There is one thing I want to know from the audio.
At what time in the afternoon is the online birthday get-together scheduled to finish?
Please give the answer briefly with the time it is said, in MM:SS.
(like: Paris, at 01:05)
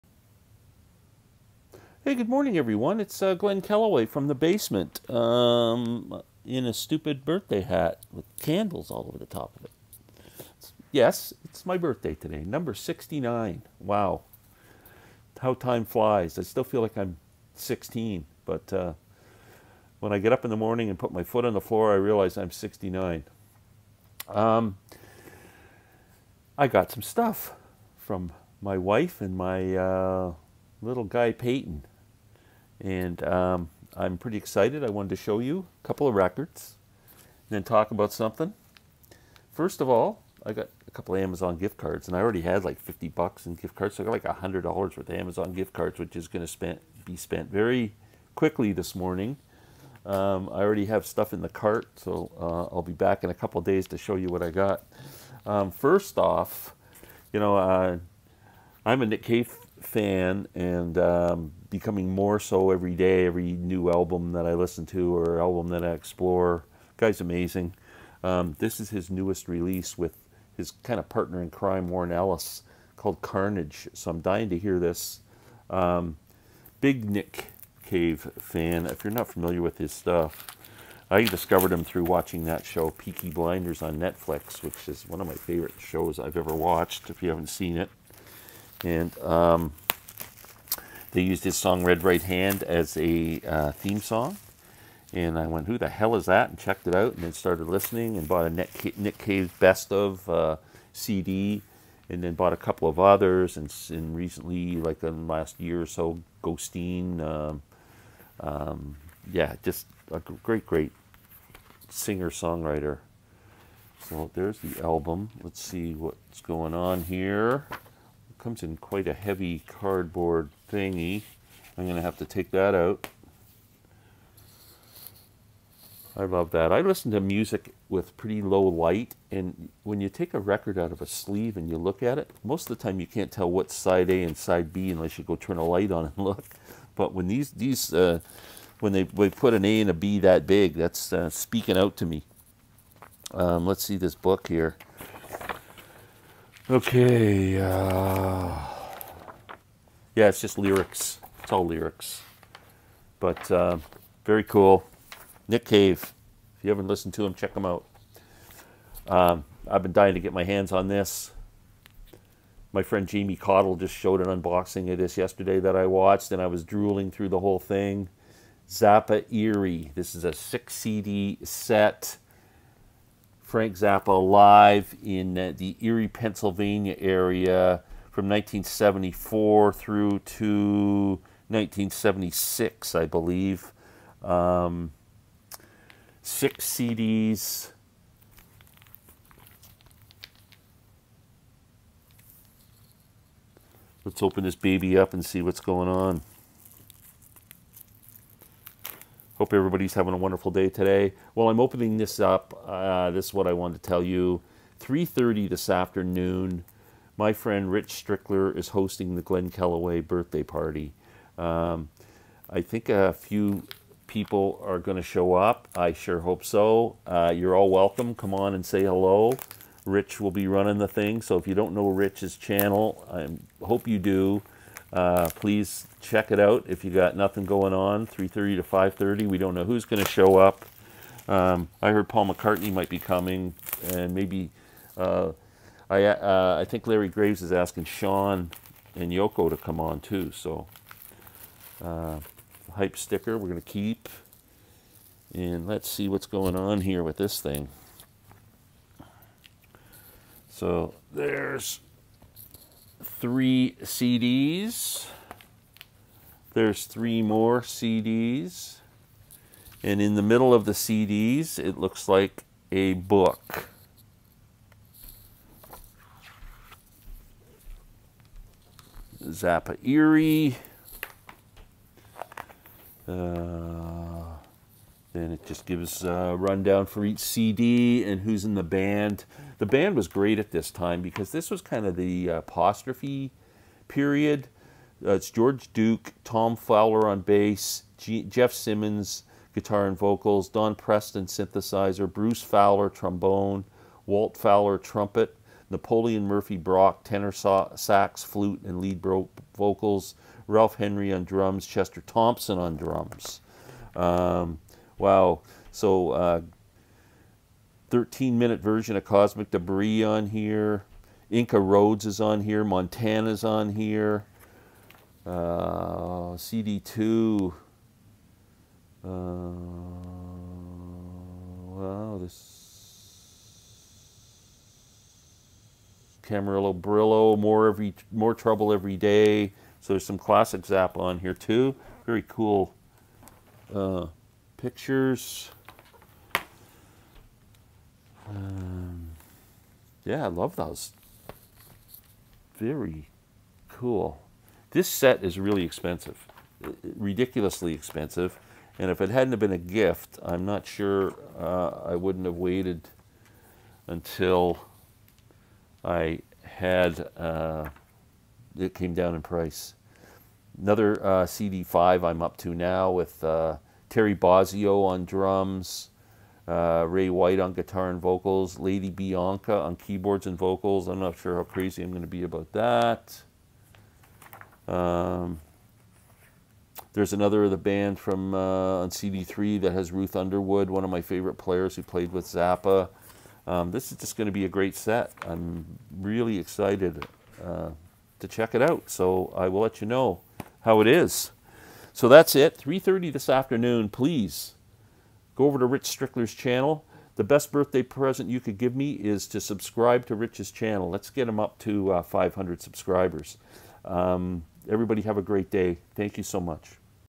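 5:30, at 03:48.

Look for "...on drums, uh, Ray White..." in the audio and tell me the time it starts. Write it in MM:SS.
06:04.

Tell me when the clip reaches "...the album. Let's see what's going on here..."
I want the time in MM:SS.
01:54.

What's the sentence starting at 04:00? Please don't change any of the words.
So uh, hype sticker we're going to keep, and let's see what's going on here with this thing.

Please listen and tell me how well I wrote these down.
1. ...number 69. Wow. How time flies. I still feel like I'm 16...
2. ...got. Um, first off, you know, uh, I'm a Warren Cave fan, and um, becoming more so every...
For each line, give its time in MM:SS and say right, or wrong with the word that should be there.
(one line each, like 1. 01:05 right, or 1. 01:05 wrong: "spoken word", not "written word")
1. 00:12 right
2. 00:54 wrong: "Nick", not "Warren".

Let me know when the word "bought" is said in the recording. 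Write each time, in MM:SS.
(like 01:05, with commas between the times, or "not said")
01:38, 01:42.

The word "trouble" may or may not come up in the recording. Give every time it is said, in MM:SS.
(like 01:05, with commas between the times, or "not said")
05:28.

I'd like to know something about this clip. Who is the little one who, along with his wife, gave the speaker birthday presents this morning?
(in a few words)
Peyton.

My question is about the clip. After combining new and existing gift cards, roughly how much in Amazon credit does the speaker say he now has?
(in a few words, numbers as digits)
$100.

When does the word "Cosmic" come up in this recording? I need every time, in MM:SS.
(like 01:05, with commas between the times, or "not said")
05:09.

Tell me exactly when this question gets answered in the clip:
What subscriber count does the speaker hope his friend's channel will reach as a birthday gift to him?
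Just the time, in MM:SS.
06:42.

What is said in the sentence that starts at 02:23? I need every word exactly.
Um, let's see this book here.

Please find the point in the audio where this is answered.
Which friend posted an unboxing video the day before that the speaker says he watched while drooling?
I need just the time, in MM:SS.
02:43.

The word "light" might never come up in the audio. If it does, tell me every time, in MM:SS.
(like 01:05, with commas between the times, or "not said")
02:08, 02:15.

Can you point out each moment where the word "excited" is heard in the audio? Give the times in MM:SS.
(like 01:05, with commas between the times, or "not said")
00:34, 06:26.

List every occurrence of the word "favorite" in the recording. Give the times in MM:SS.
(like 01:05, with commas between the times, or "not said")
01:25, 06:21.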